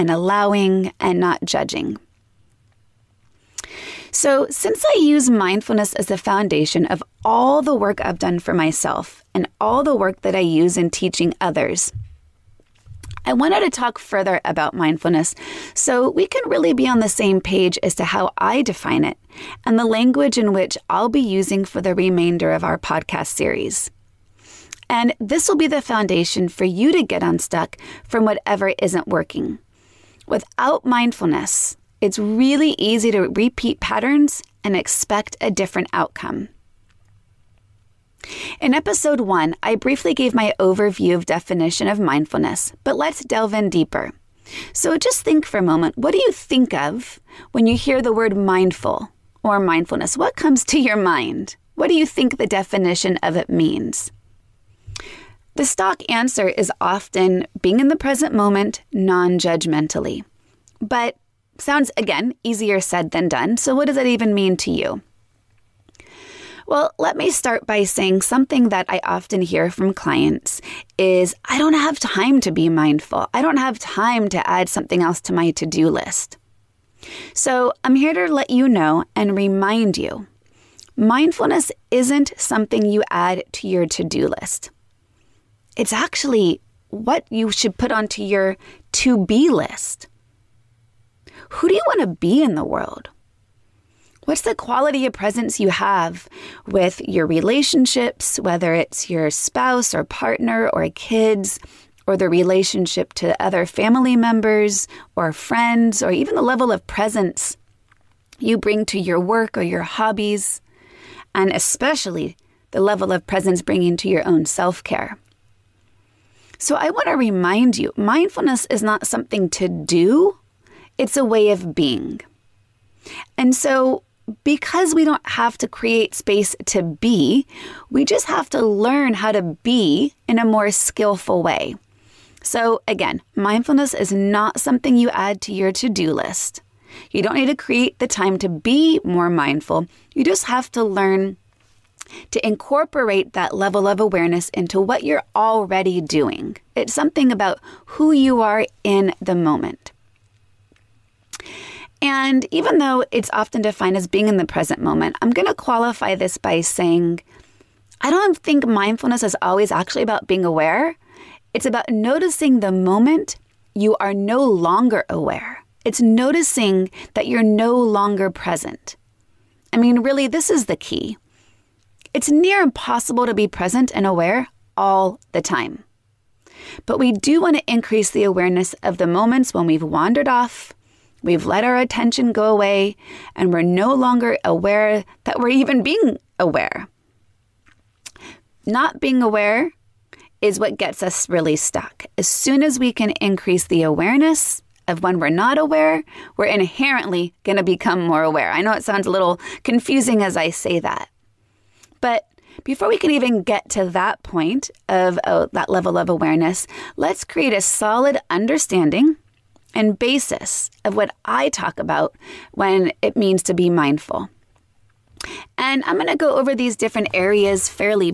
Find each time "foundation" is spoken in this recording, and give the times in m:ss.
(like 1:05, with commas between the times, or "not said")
0:06, 0:25.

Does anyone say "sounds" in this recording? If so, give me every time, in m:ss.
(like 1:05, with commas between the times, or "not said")
1:01, 3:18.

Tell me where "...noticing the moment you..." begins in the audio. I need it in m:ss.
2:41.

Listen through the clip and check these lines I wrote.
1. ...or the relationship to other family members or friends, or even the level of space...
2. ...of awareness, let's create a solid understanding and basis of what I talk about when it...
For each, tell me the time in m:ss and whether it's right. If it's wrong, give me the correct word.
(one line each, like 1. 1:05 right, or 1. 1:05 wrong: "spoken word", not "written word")
1. 1:42 wrong: "presence", not "space"
2. 3:25 right.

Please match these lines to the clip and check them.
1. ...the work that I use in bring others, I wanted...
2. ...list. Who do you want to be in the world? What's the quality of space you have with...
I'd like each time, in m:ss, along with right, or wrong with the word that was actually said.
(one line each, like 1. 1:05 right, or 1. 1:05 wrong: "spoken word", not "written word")
1. 0:09 wrong: "teaching", not "bring"
2. 1:29 wrong: "presence", not "space".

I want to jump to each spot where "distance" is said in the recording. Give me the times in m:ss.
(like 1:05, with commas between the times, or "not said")
not said.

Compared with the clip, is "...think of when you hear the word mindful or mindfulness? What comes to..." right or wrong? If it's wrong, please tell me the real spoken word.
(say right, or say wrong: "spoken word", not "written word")
right.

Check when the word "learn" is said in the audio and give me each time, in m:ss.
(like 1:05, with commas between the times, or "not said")
2:08, 2:20.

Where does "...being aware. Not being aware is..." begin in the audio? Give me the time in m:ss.
3:05.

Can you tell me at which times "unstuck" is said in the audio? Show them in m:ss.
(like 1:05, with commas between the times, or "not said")
0:27.